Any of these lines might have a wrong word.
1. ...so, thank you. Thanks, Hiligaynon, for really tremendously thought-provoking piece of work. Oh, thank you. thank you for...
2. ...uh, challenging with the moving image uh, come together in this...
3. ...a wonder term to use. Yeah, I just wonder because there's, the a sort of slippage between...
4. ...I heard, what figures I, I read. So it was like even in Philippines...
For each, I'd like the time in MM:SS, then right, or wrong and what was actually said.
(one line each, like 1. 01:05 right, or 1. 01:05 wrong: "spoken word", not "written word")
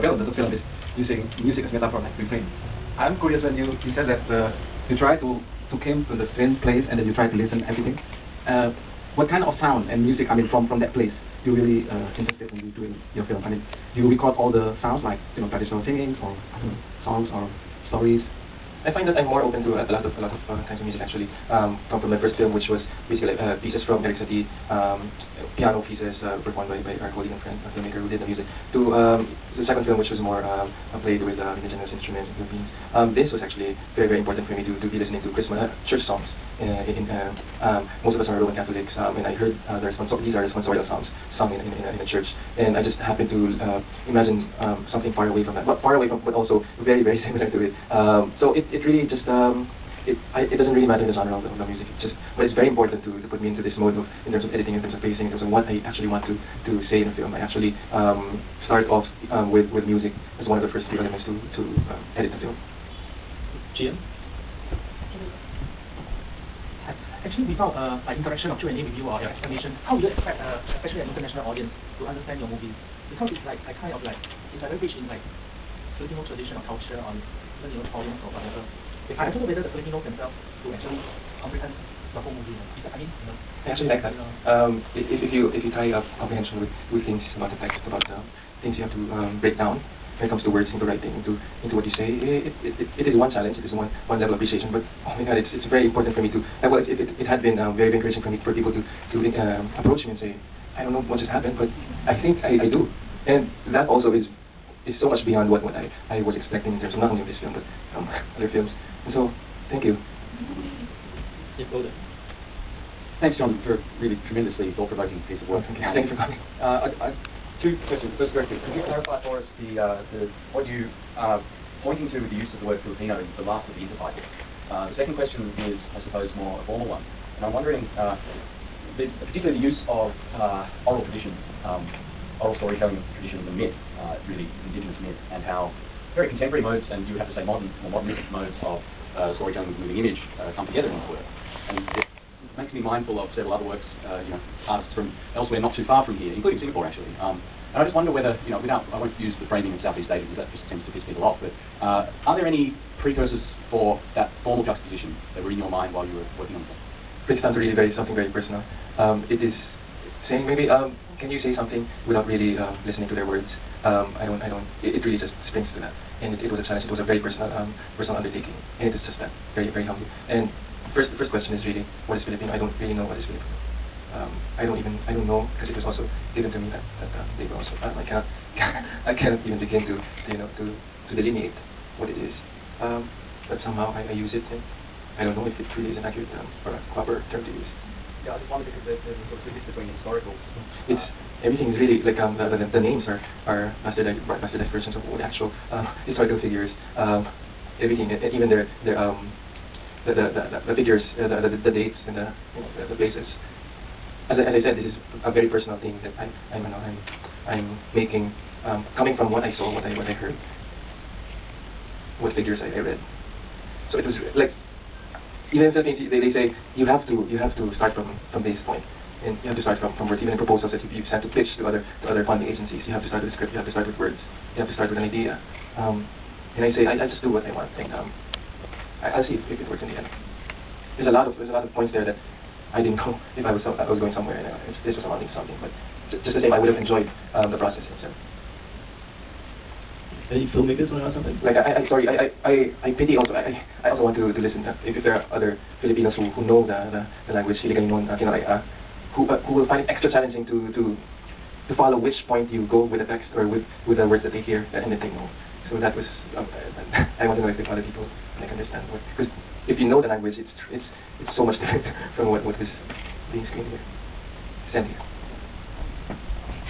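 1. 01:49 wrong: "John", not "Hiligaynon"
2. 02:19 wrong: "storytelling", not "challenging"
3. 03:06 wrong: "proper", not "wonder"
4. 03:30 right.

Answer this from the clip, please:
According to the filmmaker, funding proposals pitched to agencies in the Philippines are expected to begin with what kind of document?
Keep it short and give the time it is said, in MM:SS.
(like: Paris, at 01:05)
a script, at 03:43.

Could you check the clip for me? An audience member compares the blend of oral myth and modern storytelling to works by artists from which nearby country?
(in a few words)
Singapore.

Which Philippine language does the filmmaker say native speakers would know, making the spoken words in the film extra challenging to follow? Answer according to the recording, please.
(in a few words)
Hiligaynon.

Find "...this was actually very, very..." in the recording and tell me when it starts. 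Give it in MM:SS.
00:33.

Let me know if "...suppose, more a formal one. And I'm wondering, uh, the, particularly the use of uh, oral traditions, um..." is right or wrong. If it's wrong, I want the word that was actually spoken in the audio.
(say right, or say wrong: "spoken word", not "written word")
right.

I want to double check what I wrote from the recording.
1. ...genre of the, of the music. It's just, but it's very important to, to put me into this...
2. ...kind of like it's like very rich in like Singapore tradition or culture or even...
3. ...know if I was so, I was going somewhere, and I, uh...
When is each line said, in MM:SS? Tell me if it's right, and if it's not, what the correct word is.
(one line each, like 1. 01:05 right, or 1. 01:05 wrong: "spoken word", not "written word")
1. 00:51 right
2. 01:13 wrong: "Filipino", not "Singapore"
3. 03:52 right.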